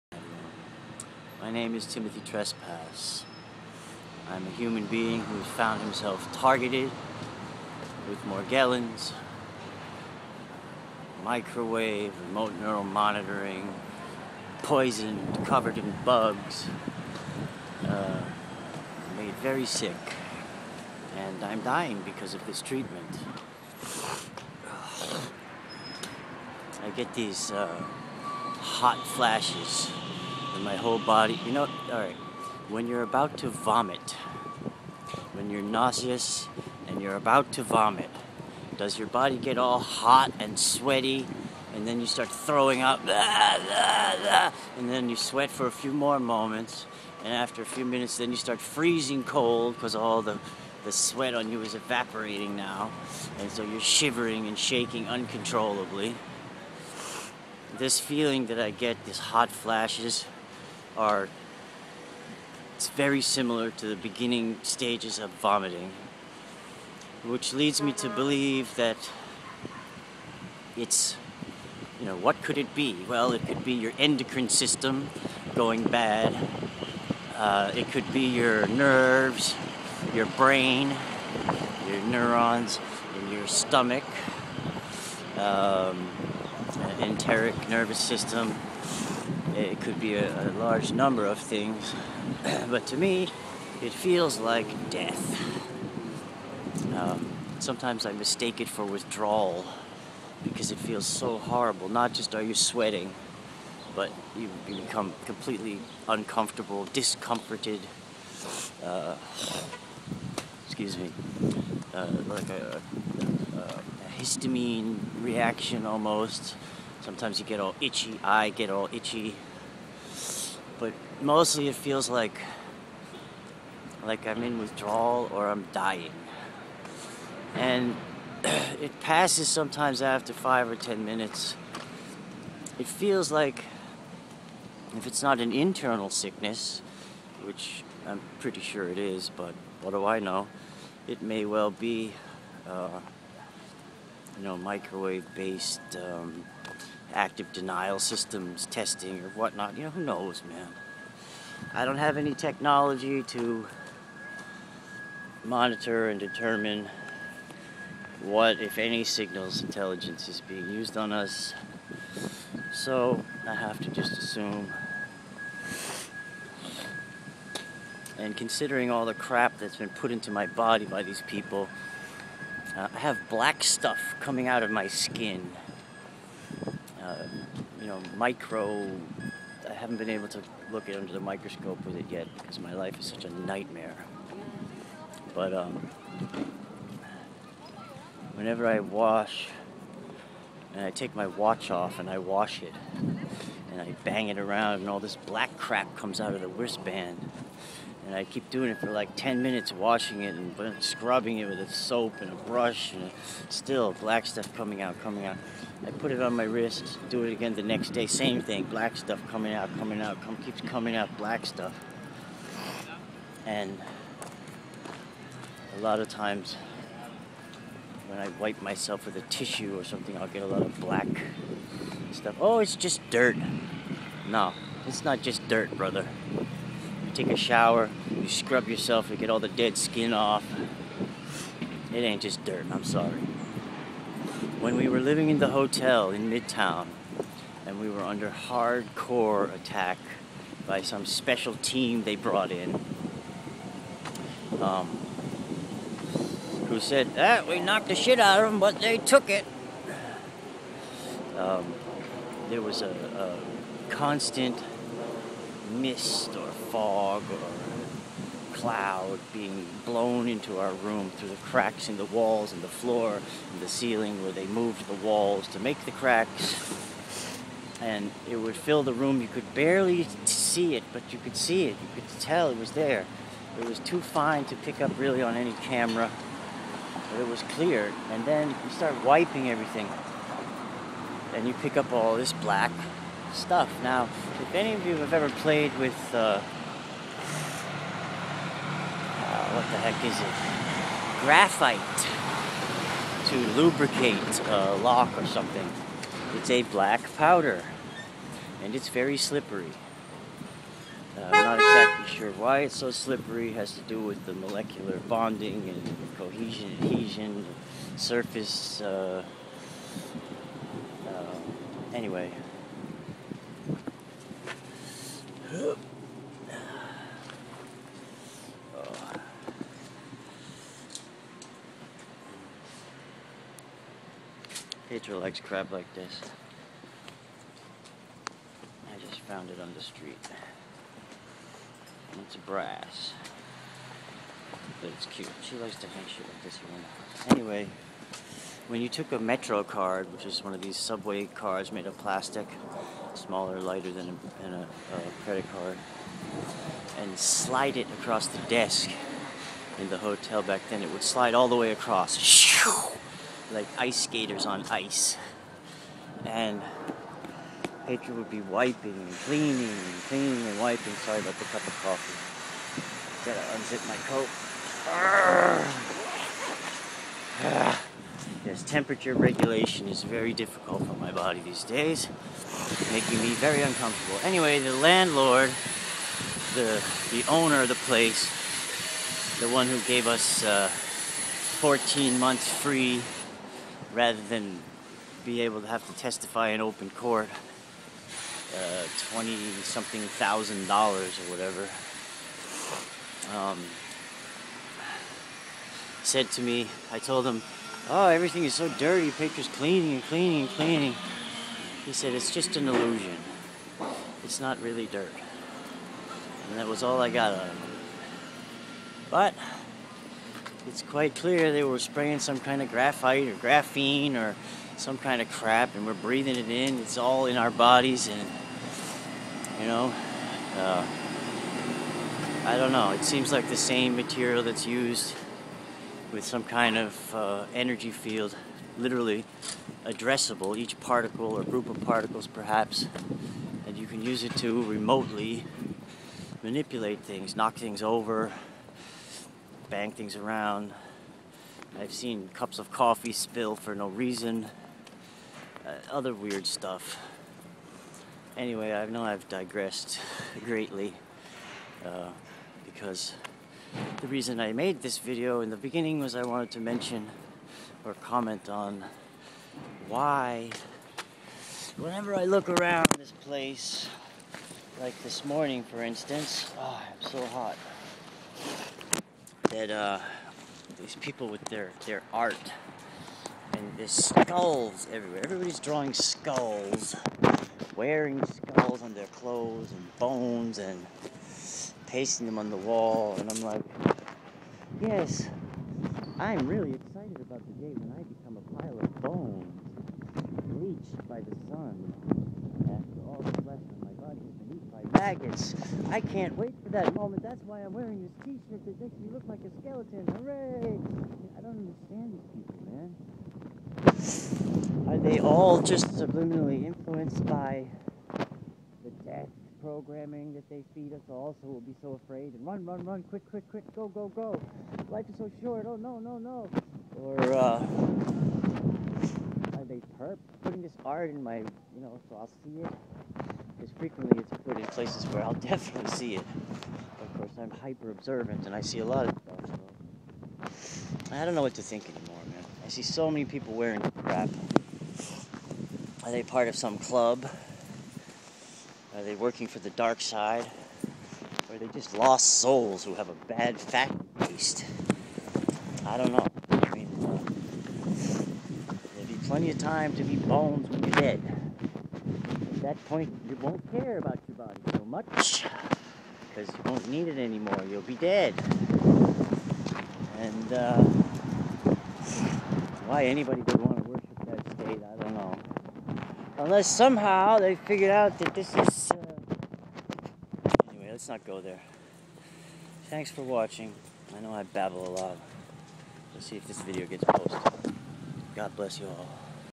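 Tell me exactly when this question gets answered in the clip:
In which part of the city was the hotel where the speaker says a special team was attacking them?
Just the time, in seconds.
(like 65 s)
236 s.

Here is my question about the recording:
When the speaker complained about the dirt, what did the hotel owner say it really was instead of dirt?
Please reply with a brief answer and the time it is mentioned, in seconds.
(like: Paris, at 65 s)
an illusion, at 402 s.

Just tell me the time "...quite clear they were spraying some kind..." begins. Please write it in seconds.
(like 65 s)
410 s.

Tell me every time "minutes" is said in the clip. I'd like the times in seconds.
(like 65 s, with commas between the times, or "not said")
47 s, 131 s, 199 s.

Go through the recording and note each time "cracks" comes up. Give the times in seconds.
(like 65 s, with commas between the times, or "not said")
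261 s, 265 s.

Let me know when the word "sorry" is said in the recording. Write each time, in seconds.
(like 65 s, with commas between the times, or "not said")
232 s, 360 s.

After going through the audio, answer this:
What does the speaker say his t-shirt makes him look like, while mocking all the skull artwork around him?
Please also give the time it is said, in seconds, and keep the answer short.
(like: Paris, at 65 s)
a skeleton, at 499 s.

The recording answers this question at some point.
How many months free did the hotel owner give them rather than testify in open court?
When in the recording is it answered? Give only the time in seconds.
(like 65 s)
380 s.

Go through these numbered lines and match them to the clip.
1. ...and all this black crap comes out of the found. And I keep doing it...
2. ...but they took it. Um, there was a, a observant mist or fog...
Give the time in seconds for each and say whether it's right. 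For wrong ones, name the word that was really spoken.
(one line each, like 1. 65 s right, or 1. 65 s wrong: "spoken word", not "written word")
1. 194 s wrong: "wristband", not "found"
2. 248 s wrong: "constant", not "observant".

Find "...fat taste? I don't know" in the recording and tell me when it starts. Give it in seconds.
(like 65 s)
543 s.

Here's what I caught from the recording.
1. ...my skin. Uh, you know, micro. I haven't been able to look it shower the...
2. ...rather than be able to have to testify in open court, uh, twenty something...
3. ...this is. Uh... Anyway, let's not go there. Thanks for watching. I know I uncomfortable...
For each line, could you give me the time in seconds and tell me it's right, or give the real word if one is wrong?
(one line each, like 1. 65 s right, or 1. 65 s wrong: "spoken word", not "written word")
1. 174 s wrong: "under", not "shower"
2. 383 s right
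3. 568 s wrong: "babble", not "uncomfortable".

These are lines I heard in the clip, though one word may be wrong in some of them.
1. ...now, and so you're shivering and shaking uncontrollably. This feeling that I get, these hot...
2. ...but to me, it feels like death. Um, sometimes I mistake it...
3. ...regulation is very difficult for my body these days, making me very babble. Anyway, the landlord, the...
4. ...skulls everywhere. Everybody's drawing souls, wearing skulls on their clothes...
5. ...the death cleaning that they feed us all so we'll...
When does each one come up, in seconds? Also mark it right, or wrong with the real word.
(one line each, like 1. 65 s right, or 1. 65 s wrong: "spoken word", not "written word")
1. 52 s right
2. 92 s right
3. 369 s wrong: "uncomfortable", not "babble"
4. 473 s wrong: "skulls", not "souls"
5. 508 s wrong: "programming", not "cleaning".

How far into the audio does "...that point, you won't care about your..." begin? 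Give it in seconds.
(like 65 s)
552 s.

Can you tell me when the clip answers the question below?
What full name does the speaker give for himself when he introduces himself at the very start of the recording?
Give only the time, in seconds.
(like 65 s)
1 s.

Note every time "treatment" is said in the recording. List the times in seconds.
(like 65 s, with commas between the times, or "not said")
22 s.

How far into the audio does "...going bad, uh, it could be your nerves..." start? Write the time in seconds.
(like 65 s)
75 s.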